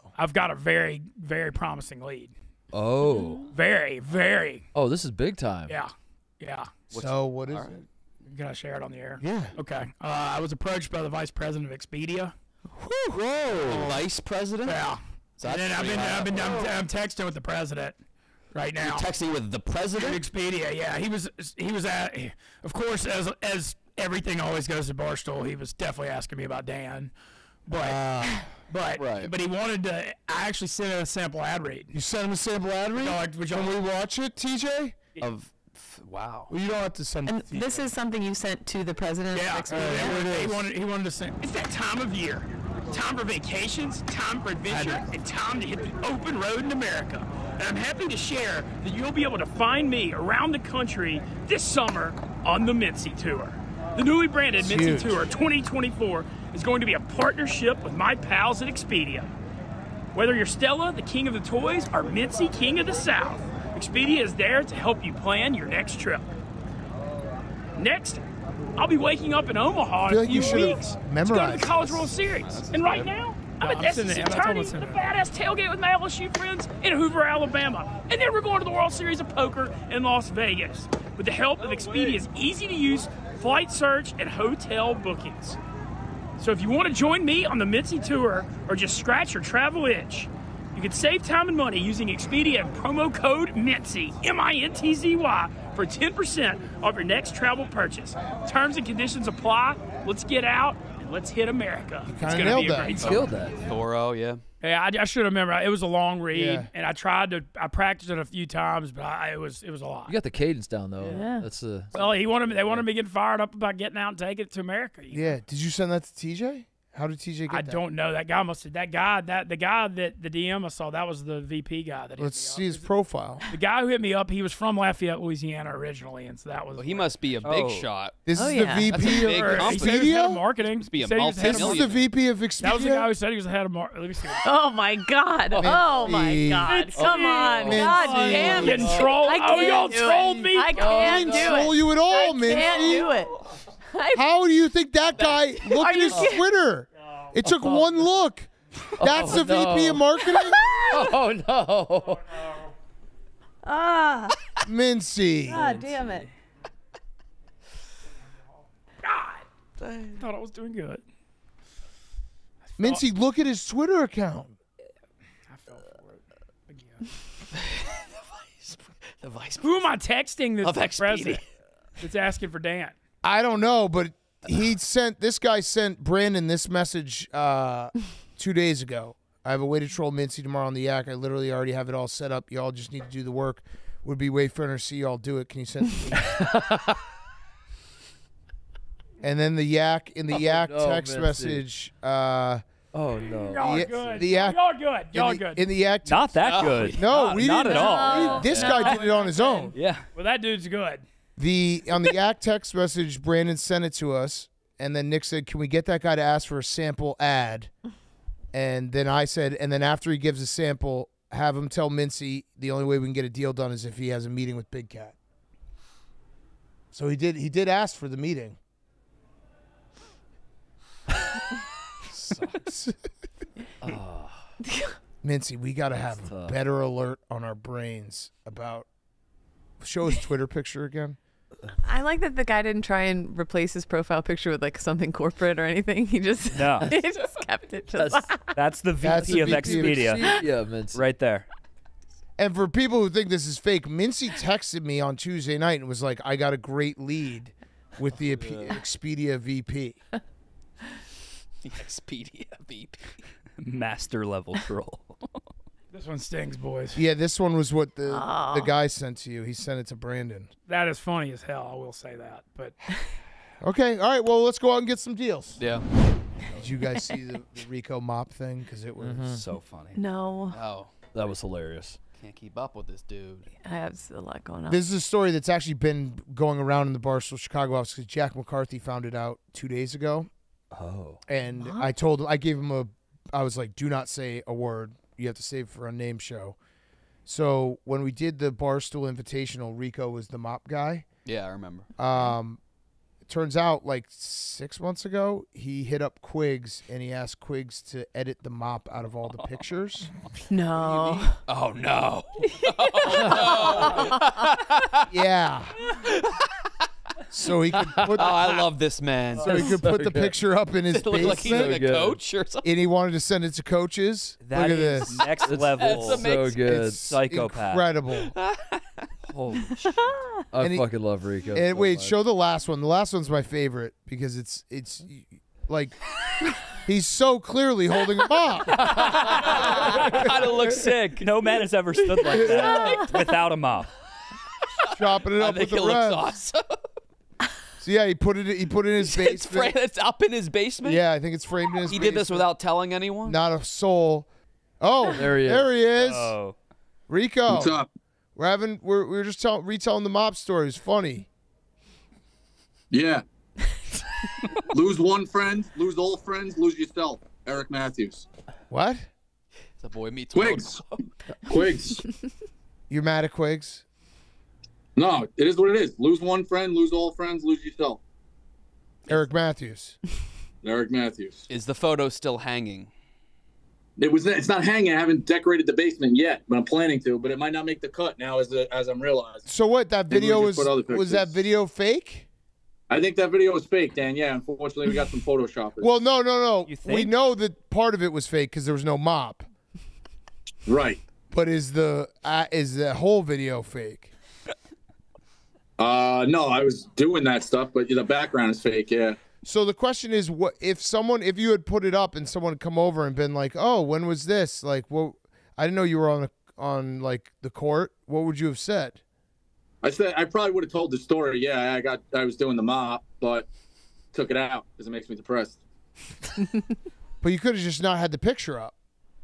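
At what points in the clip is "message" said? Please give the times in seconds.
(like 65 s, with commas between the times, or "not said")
176 s, 191 s, 202 s.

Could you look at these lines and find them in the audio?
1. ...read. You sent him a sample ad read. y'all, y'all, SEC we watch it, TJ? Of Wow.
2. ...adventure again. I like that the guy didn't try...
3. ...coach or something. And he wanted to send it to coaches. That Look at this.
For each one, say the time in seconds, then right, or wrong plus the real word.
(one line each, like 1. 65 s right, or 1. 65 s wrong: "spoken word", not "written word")
1. 31 s wrong: "Can", not "SEC"
2. 230 s wrong: "picture", not "adventure"
3. 311 s right.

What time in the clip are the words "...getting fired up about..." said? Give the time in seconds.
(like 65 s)
112 s.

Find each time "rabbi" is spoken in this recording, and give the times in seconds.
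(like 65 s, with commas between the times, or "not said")
not said.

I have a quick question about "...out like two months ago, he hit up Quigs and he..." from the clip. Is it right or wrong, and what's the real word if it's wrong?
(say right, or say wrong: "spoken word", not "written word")
wrong: "six", not "two".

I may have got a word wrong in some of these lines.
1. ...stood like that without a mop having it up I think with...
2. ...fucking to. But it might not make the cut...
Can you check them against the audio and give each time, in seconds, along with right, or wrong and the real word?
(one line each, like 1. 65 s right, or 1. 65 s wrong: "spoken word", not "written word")
1. 331 s wrong: "chopping", not "having"
2. 376 s wrong: "planning", not "fucking".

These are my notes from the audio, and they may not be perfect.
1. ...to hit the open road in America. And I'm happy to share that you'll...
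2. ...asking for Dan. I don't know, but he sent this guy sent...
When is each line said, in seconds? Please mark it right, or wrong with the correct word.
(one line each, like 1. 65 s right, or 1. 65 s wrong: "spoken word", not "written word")
1. 45 s right
2. 172 s right.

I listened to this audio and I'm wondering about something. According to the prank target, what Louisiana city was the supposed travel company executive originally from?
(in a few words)
Lafayette.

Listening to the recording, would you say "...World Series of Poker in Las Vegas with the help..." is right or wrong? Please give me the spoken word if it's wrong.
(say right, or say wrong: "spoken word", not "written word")
right.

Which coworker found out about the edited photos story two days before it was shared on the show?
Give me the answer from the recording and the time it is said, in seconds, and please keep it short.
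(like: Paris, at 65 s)
Jack McCarthy, at 278 s.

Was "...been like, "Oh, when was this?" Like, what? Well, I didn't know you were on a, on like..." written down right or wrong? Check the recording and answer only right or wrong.
right.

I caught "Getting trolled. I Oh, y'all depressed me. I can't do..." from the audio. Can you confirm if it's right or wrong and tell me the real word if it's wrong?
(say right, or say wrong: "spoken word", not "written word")
wrong: "trolled", not "depressed".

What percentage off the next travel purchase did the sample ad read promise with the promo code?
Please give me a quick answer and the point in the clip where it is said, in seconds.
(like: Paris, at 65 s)
10%, at 95 s.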